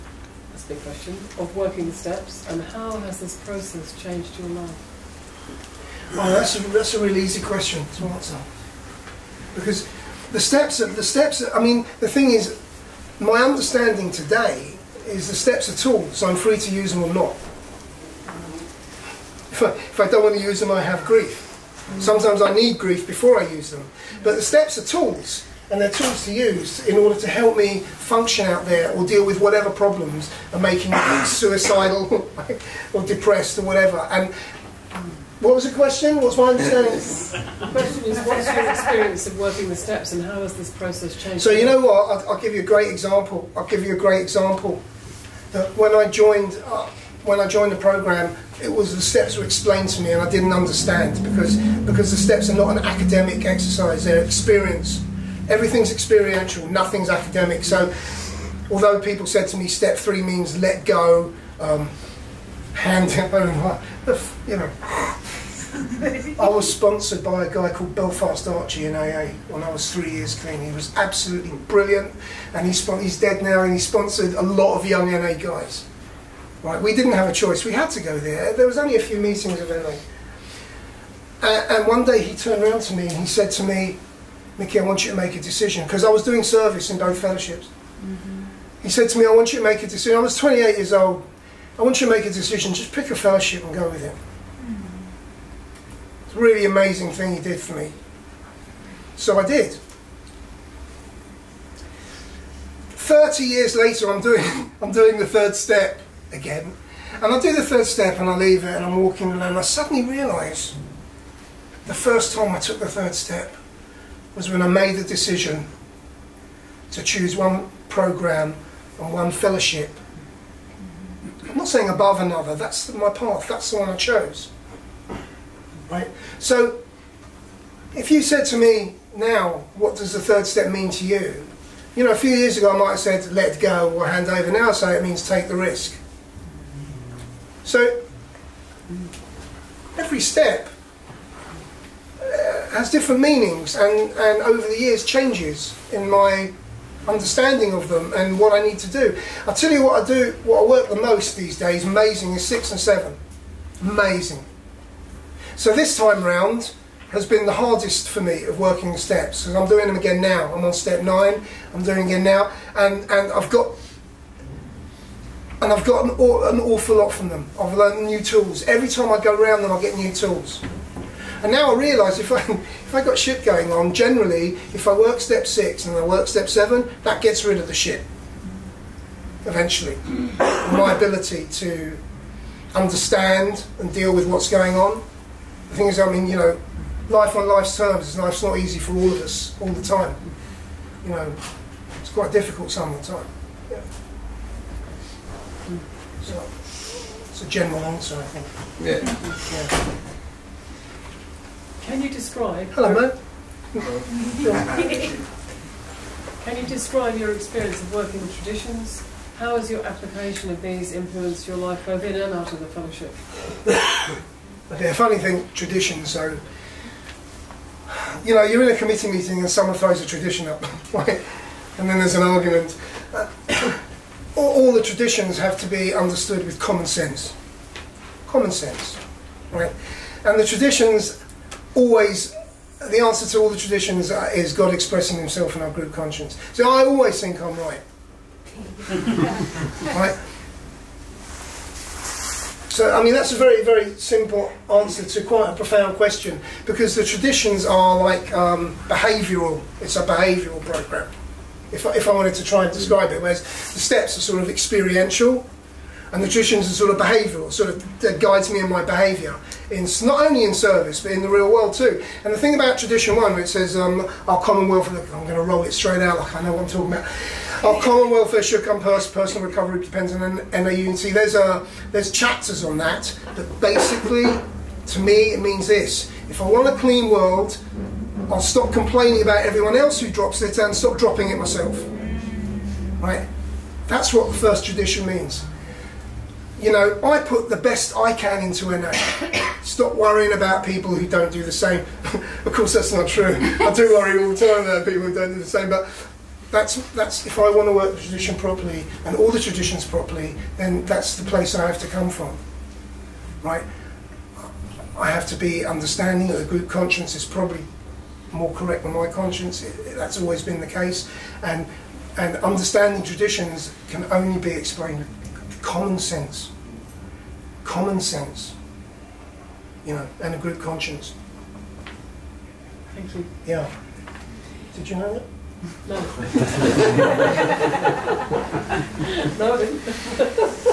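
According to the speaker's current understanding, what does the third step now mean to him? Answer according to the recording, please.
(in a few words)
Take the risk.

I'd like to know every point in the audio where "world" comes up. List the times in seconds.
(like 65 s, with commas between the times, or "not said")
261 s, 277 s.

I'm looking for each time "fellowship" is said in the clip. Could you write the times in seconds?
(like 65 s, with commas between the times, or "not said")
87 s, 93 s, 119 s, 212 s.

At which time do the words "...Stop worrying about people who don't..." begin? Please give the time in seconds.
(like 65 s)
289 s.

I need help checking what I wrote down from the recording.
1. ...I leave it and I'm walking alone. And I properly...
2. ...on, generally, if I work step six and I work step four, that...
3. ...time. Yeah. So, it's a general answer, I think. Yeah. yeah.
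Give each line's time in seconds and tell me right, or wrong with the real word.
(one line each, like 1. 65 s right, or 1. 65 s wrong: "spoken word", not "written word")
1. 108 s wrong: "suddenly", not "properly"
2. 173 s wrong: "seven", not "four"
3. 193 s right.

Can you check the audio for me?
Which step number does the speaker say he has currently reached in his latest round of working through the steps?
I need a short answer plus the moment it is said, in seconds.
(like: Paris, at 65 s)
Step 9, at 160 s.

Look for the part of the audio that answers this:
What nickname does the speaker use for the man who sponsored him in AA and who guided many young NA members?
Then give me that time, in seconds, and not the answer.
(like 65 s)
67 s.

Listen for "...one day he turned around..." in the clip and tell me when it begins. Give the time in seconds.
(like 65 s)
81 s.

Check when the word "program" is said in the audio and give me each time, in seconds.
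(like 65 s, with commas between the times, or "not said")
47 s, 117 s, 250 s.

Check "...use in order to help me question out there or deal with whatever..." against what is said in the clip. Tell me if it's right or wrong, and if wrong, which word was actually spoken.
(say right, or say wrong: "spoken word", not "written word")
wrong: "function", not "question".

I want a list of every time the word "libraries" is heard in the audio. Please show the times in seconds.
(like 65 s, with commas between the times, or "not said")
not said.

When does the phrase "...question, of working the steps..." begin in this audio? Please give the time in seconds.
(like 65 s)
0 s.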